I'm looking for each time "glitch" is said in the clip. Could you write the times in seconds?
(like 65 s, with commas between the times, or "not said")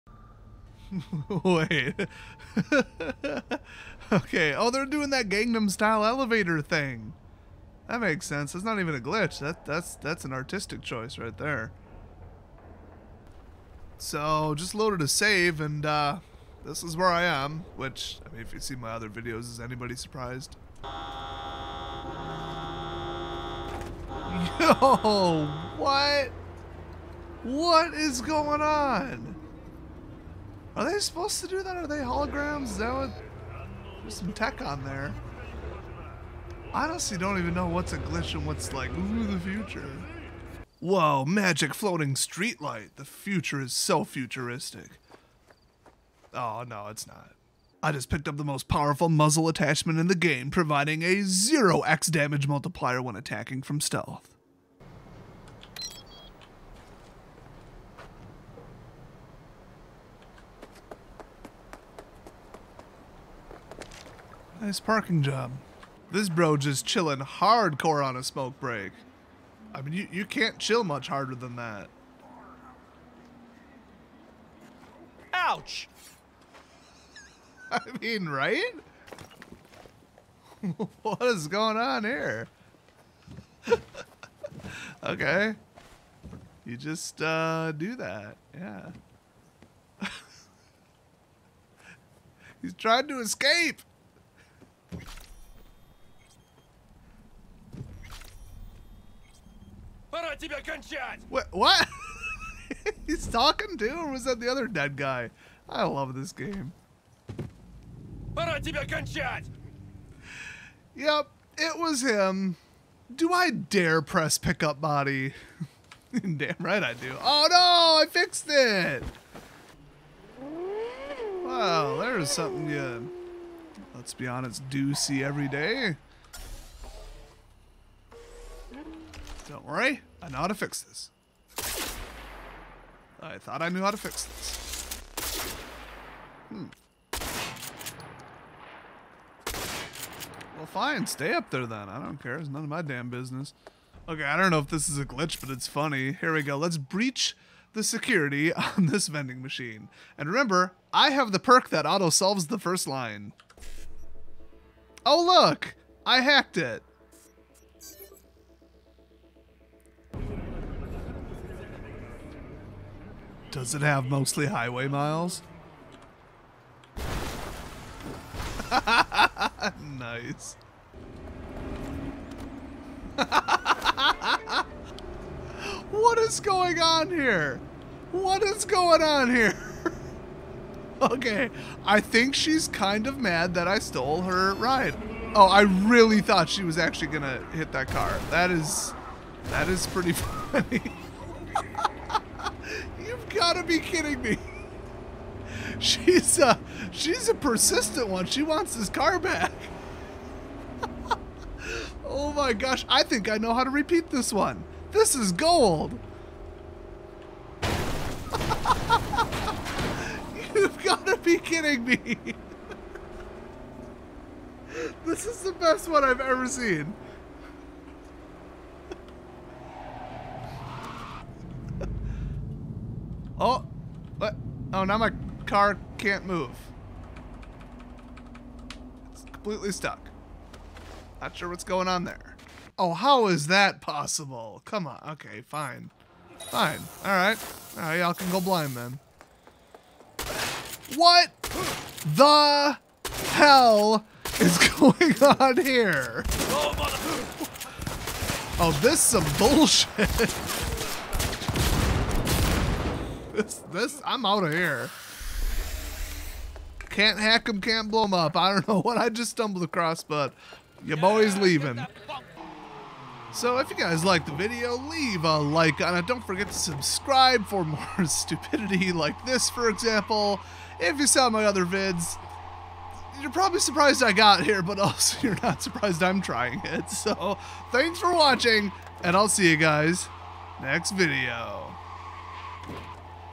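8 s, 37 s, 145 s.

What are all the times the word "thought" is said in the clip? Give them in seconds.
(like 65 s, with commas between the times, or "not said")
133 s, 186 s.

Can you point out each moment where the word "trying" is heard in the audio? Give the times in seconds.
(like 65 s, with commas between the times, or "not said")
92 s, 276 s.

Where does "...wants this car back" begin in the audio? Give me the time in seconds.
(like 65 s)
198 s.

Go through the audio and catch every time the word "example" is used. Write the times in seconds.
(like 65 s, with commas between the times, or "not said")
269 s.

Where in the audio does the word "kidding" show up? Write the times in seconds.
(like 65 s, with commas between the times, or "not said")
193 s, 211 s.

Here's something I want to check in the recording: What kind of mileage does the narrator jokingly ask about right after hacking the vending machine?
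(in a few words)
highway miles.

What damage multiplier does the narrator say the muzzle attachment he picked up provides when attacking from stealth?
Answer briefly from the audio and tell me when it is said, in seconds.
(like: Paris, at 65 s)
0x, at 51 s.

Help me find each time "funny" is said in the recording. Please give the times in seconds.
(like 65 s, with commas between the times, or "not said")
145 s, 190 s.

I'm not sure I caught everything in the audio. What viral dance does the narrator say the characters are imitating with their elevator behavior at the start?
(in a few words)
Gangnam Style.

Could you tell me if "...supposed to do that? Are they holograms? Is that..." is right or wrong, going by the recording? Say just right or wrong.
right.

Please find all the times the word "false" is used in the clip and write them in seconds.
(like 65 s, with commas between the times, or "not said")
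not said.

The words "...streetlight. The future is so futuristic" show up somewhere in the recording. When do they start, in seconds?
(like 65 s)
42 s.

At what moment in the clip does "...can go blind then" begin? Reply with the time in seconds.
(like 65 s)
238 s.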